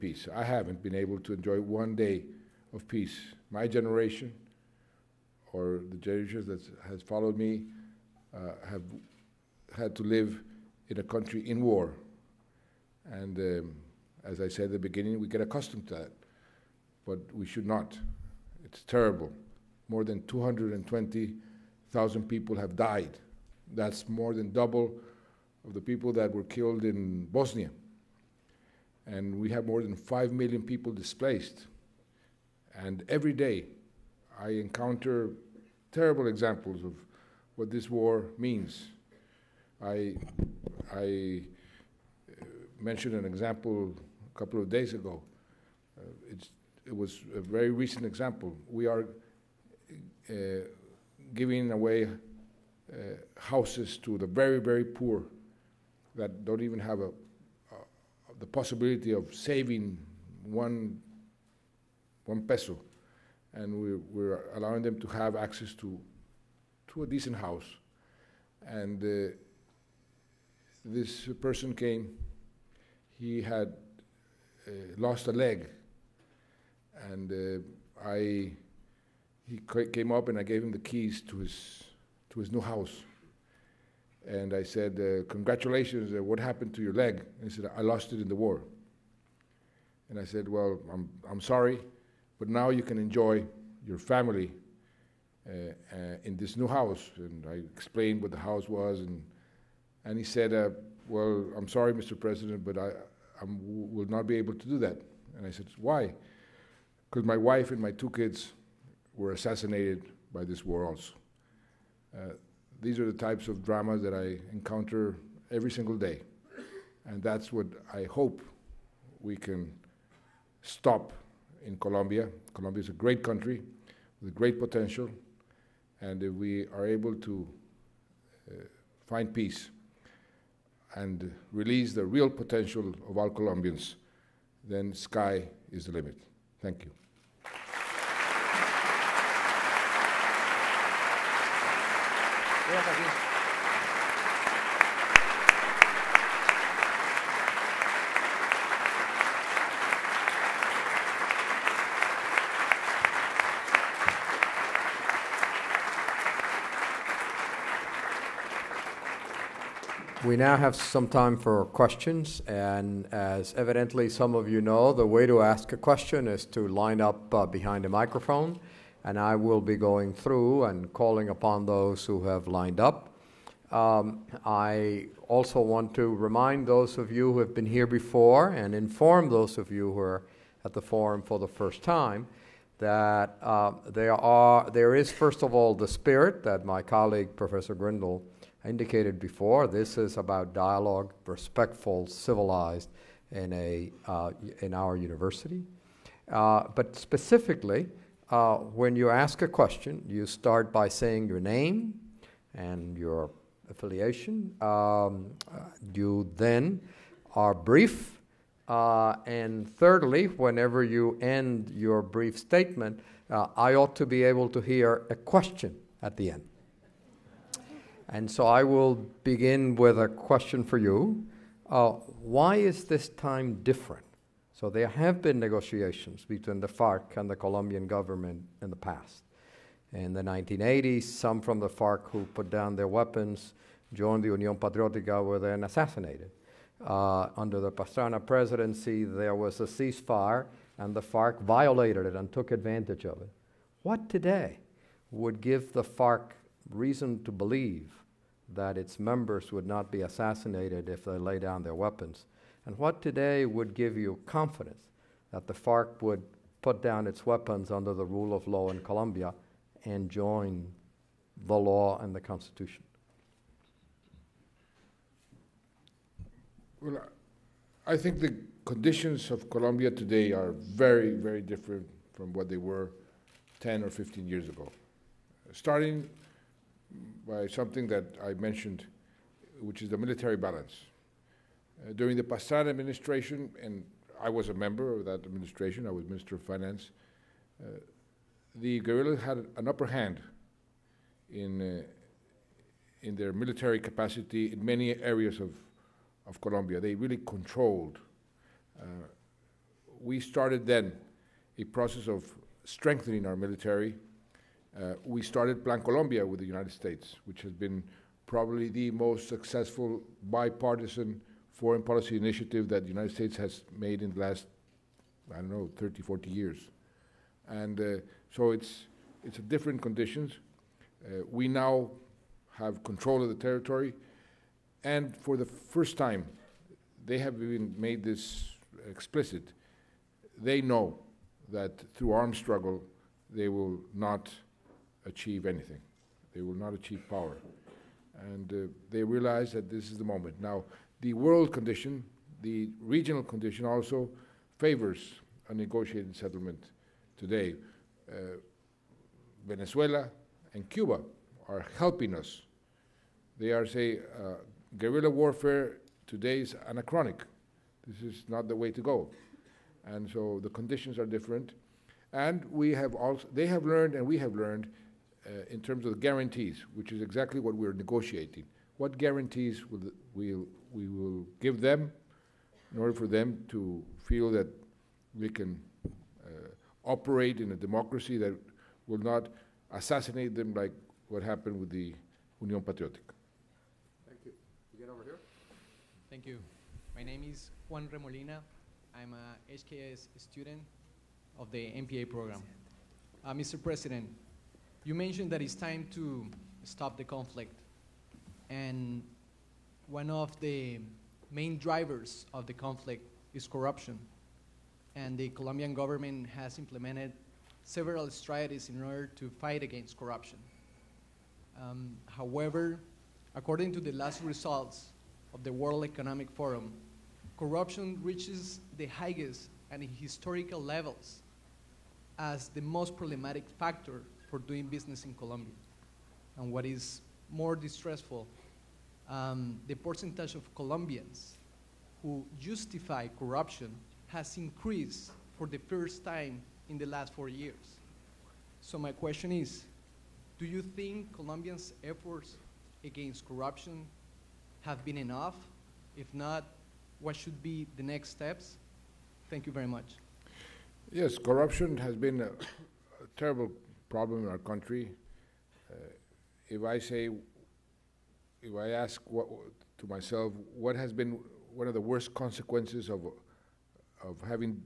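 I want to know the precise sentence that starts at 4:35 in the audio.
Starting by something that I mentioned, which is the military balance.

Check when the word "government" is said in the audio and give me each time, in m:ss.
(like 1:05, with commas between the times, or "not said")
3:47, 6:45.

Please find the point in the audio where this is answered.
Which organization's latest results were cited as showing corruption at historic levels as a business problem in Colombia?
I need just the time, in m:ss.
6:55.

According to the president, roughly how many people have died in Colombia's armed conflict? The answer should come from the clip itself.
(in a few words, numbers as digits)
More than 220,000.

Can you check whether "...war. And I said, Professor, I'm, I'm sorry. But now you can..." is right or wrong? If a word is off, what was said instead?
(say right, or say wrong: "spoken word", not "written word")
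wrong: "Well", not "Professor".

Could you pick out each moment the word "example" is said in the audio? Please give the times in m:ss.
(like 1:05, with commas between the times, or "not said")
0:36, 0:43, 0:48.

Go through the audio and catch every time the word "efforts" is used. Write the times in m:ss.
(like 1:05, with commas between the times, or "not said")
7:21.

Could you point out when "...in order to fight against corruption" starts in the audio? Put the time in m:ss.
6:48.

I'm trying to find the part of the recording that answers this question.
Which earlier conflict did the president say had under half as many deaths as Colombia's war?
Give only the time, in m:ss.
0:27.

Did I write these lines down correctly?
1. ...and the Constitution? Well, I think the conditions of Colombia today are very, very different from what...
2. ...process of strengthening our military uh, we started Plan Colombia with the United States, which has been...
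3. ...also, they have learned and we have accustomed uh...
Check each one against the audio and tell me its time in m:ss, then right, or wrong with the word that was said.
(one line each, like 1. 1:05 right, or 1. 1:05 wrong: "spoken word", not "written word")
1. 4:22 right
2. 5:01 right
3. 6:02 wrong: "learned", not "accustomed".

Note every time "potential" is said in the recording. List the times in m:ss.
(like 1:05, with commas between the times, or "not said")
2:04, 2:12.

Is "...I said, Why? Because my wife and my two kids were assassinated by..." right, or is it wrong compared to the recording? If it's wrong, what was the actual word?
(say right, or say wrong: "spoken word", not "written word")
right.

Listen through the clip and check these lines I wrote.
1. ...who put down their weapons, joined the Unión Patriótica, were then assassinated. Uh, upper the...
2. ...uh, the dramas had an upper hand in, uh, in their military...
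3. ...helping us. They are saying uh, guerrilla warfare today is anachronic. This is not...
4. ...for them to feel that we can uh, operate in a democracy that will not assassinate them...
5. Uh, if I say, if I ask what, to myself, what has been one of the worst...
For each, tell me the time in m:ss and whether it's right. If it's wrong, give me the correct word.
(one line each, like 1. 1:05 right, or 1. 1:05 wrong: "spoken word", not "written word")
1. 3:52 wrong: "under", not "upper"
2. 4:47 wrong: "guerrillas", not "dramas"
3. 5:51 right
4. 6:12 right
5. 7:35 right.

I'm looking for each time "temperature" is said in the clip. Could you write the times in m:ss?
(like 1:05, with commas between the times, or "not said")
not said.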